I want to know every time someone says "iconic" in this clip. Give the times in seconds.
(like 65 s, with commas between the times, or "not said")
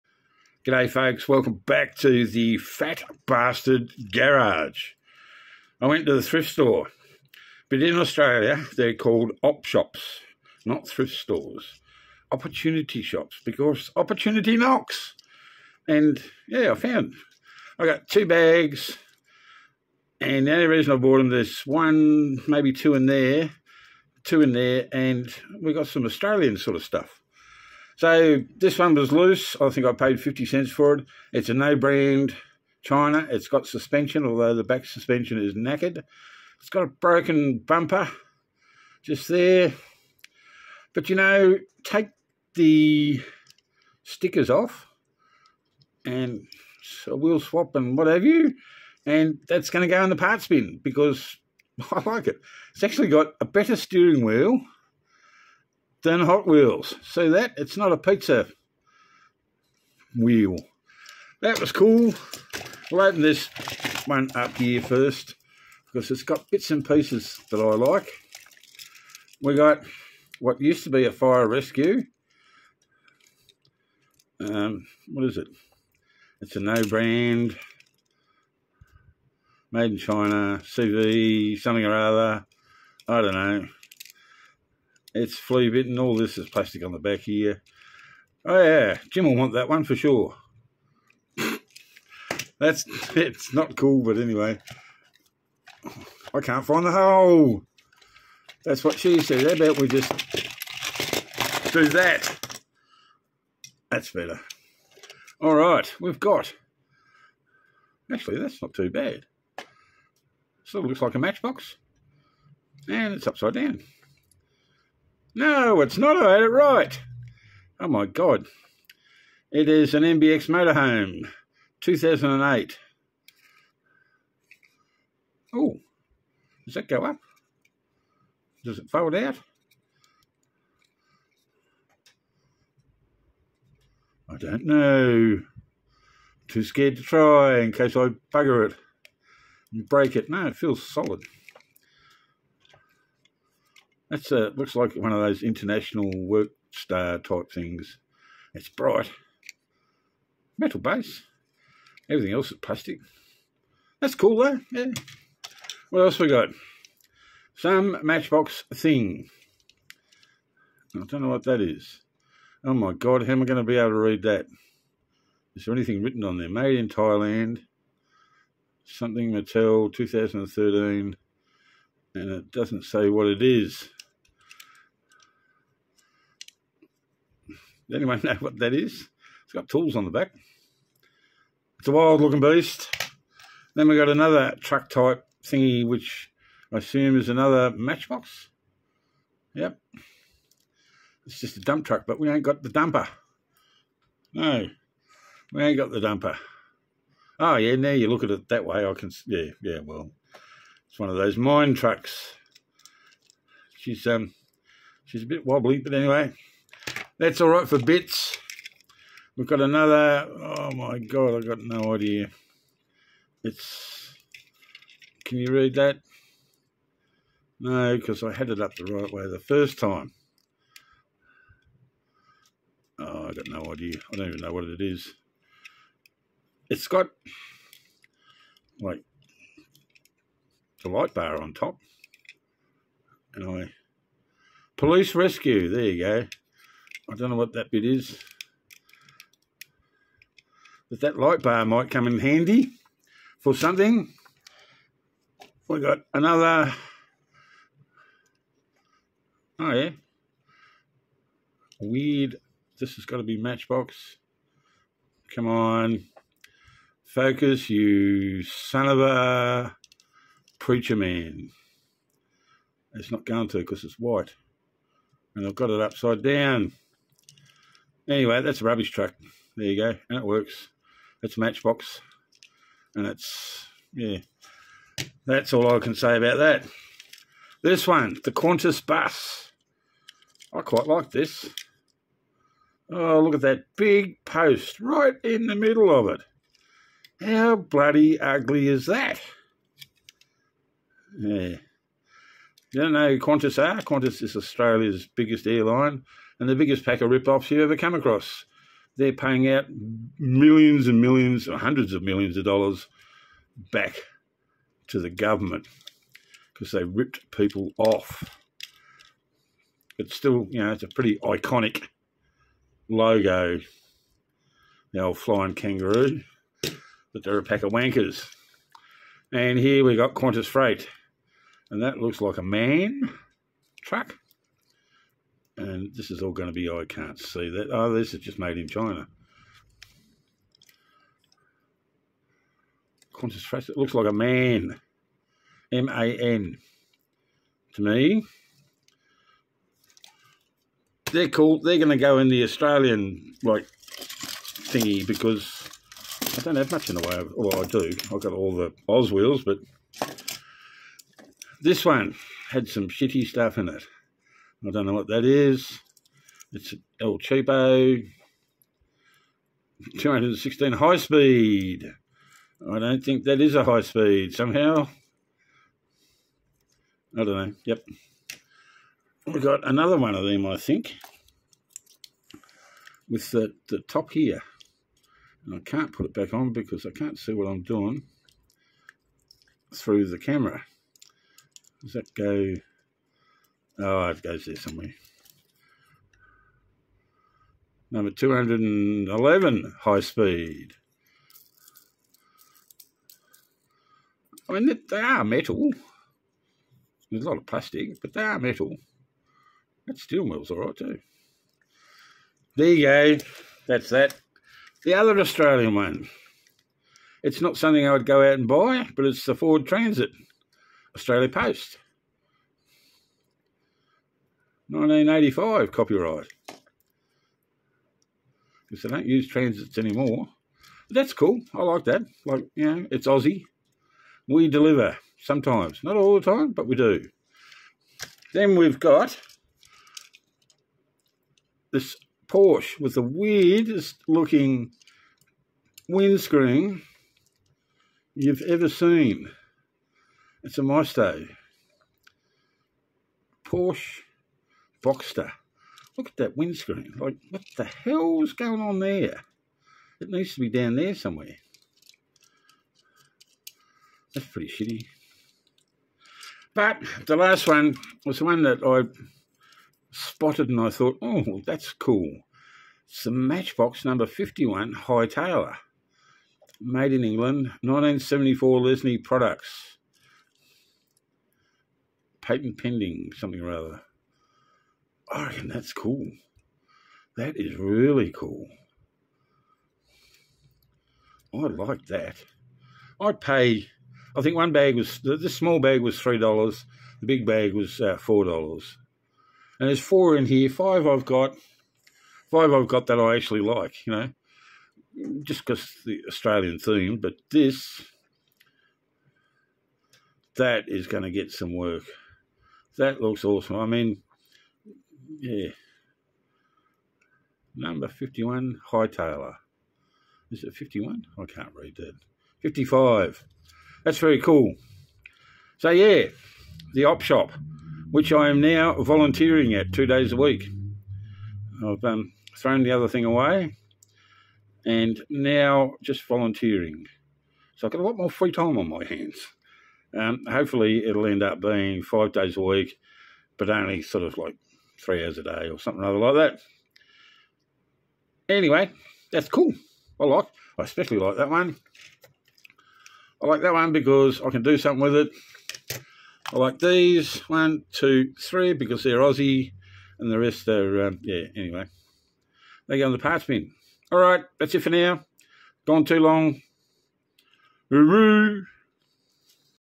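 311 s.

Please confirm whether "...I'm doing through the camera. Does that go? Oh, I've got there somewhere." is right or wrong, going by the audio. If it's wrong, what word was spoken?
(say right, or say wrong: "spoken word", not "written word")
right.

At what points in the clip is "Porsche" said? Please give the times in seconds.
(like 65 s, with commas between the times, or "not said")
432 s, 443 s.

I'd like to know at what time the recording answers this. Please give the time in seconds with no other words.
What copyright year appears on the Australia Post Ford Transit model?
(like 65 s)
414 s.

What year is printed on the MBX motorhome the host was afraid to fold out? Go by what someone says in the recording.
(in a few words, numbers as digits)
2008.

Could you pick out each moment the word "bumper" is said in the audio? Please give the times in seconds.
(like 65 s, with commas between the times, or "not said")
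37 s.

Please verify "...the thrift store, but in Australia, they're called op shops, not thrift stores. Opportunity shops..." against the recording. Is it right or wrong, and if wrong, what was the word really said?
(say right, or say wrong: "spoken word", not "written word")
right.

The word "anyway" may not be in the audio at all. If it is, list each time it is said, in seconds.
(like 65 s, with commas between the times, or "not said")
94 s, 205 s, 268 s, 538 s, 551 s.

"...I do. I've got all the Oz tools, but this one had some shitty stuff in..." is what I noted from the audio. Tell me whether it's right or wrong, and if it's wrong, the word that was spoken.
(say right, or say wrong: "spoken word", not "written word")
wrong: "wheels", not "tools".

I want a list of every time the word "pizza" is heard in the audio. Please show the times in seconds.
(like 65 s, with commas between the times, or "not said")
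57 s.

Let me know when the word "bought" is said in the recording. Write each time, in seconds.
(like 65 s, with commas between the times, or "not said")
20 s.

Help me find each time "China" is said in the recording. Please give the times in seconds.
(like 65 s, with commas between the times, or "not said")
32 s, 79 s, 328 s.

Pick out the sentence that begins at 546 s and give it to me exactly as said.
I like these one, two, three because they're Aussie, and the rest are um, yeah.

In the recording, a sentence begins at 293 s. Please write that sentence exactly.
Qantas is Australia's biggest airline and the biggest pack of rip-offs you ever come across.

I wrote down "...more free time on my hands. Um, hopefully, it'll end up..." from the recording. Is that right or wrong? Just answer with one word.
right.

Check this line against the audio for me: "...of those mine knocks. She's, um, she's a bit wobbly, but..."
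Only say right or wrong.
wrong.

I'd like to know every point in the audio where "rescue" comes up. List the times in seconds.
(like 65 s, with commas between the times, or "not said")
71 s, 235 s.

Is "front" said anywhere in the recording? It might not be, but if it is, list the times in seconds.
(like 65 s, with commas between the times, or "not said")
not said.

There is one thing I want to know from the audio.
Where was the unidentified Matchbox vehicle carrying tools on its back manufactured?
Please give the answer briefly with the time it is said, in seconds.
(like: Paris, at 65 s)
Thailand, at 166 s.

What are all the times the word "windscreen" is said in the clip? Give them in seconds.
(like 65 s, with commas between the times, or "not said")
435 s, 446 s.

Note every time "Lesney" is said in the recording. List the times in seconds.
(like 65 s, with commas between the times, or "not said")
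468 s.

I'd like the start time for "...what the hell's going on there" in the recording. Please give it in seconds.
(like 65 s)
447 s.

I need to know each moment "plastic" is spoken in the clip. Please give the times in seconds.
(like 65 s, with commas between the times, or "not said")
86 s, 152 s, 397 s.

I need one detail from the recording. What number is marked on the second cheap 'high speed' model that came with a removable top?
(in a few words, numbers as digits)
211.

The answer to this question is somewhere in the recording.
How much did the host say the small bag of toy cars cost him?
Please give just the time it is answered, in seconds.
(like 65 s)
485 s.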